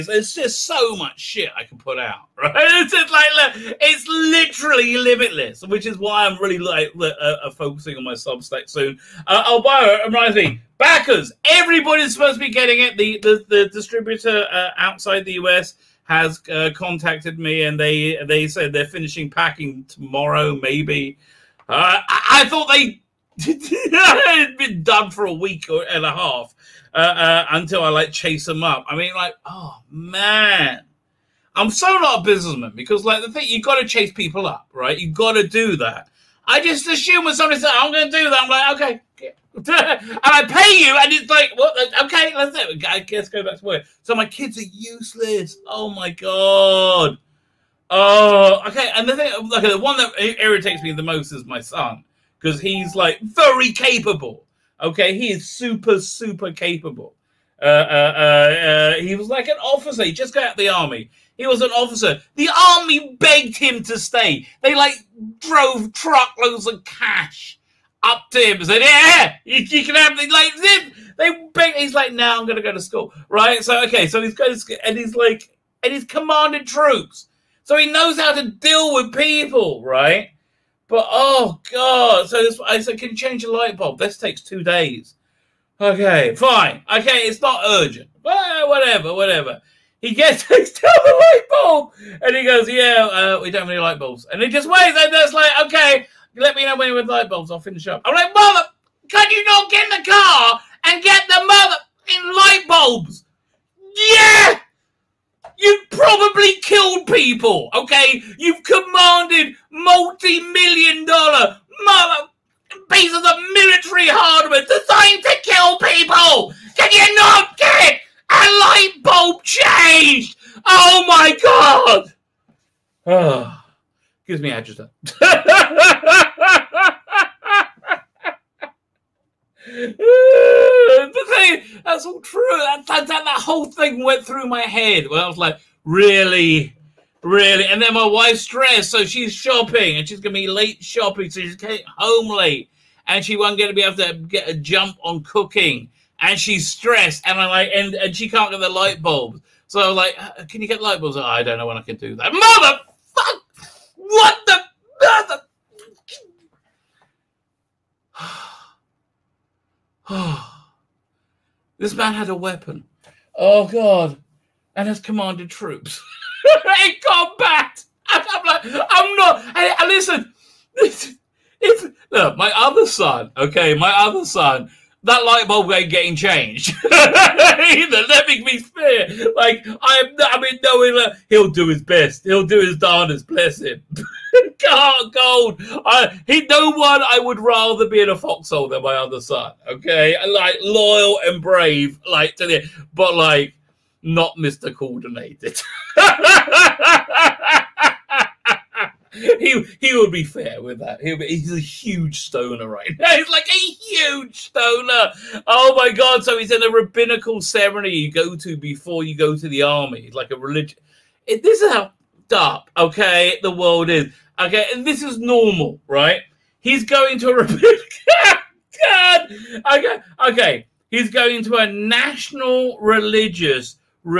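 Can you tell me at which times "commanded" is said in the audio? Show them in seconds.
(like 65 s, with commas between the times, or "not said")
76 s, 108 s, 164 s.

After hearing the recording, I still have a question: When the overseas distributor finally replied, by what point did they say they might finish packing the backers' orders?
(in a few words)
tomorrow.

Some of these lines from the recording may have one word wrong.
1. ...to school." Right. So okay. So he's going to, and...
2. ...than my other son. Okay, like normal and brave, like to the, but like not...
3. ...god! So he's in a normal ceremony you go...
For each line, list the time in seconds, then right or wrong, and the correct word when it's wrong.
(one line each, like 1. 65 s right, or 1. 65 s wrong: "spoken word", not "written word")
1. 72 s right
2. 188 s wrong: "loyal", not "normal"
3. 205 s wrong: "rabbinical", not "normal".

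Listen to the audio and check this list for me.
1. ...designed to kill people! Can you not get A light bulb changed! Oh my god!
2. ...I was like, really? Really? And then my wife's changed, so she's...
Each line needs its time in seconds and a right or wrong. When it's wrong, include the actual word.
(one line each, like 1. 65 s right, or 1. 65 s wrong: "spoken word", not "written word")
1. 114 s right
2. 135 s wrong: "stressed", not "changed".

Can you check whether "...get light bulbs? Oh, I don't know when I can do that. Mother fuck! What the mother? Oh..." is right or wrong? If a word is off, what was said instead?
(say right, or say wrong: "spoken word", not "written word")
right.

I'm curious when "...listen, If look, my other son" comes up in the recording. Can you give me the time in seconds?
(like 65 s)
169 s.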